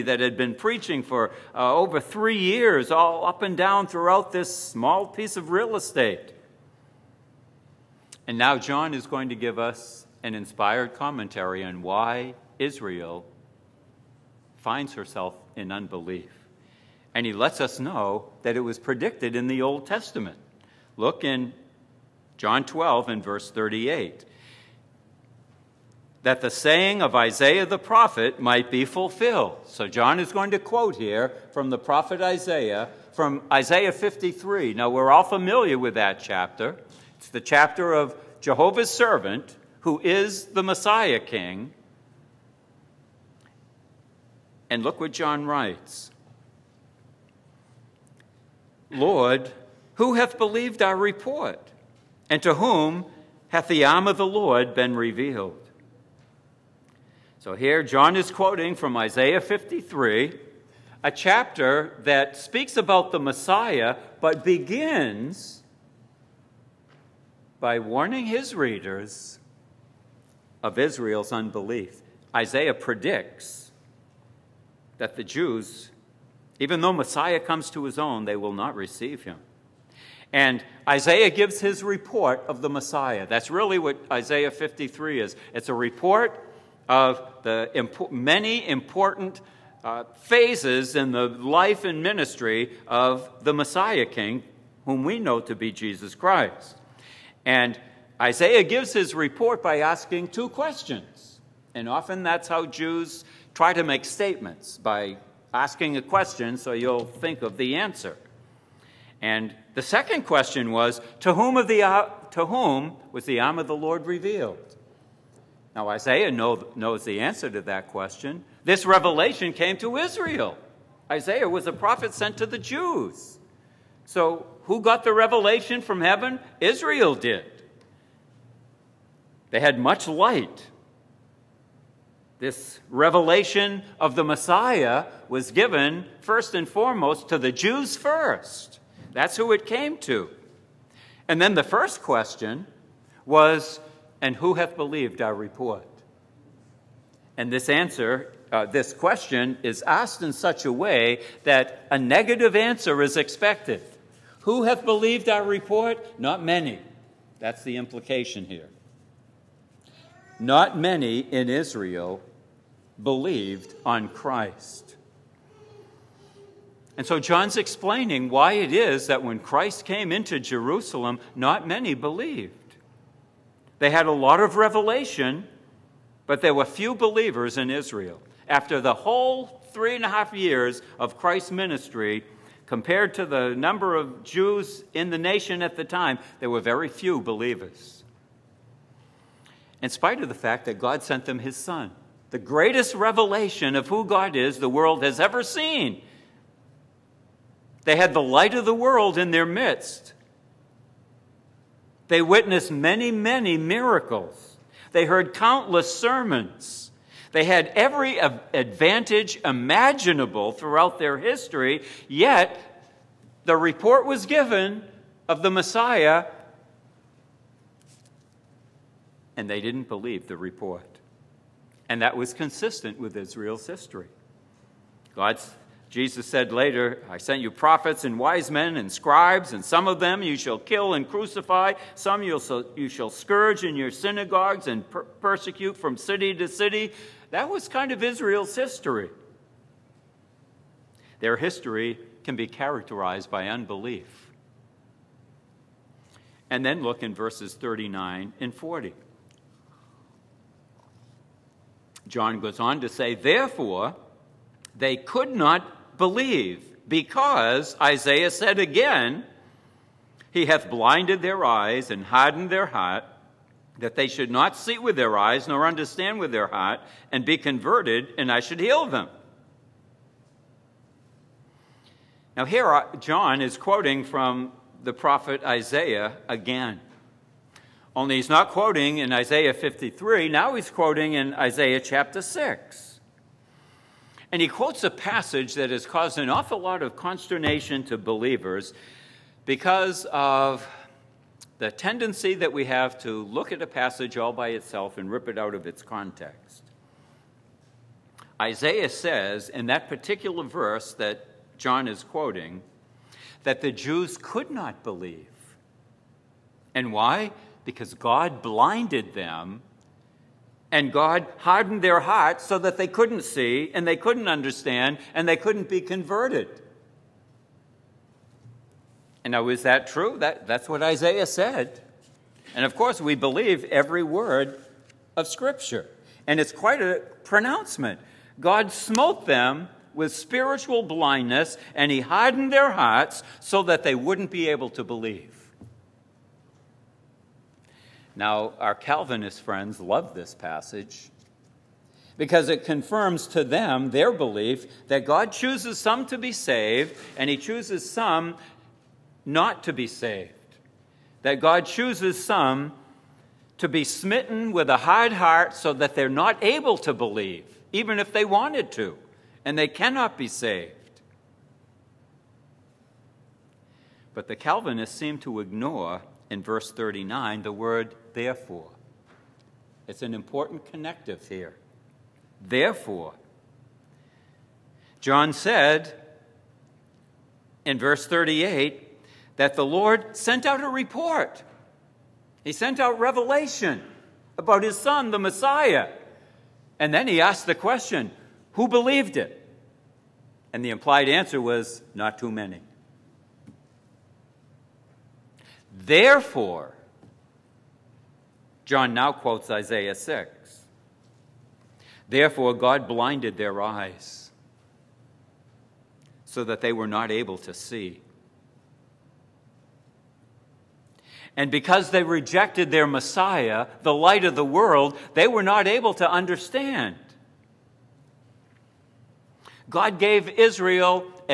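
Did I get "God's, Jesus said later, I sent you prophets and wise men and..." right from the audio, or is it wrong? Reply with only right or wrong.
right.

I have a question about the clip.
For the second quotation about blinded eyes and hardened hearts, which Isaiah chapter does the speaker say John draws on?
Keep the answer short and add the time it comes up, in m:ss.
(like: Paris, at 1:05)
Isaiah chapter 6, at 4:41.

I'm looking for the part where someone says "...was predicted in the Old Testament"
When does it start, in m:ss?
0:18.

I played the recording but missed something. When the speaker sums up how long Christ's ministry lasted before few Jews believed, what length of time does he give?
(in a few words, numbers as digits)
three and a half years.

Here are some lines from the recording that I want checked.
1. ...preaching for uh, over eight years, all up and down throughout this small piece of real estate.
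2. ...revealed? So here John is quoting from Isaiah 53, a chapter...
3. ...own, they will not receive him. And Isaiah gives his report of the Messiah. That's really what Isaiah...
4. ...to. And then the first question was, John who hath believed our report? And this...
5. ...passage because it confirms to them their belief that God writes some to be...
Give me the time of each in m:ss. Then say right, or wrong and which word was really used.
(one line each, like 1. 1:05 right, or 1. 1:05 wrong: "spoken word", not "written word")
1. 0:00 wrong: "three", not "eight"
2. 0:54 right
3. 1:17 right
4. 2:19 wrong: "And", not "John"
5. 5:40 wrong: "chooses", not "writes".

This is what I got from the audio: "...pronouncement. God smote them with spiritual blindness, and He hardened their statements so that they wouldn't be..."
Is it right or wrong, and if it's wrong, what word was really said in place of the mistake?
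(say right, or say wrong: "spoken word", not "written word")
wrong: "hearts", not "statements".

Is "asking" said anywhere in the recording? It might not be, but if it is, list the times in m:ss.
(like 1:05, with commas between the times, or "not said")
1:39, 1:45.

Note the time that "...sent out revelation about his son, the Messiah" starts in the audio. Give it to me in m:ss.
6:22.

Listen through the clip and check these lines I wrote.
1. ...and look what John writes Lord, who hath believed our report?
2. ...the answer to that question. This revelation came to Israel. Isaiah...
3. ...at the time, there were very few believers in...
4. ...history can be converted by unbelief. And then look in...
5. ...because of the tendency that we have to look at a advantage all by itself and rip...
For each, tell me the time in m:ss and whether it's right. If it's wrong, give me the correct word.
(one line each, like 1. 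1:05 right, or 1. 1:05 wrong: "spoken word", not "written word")
1. 0:44 right
2. 1:57 right
3. 3:05 right
4. 4:01 wrong: "characterized", not "converted"
5. 4:49 wrong: "passage", not "advantage".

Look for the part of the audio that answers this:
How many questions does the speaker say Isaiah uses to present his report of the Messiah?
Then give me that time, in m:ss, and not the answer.
1:40.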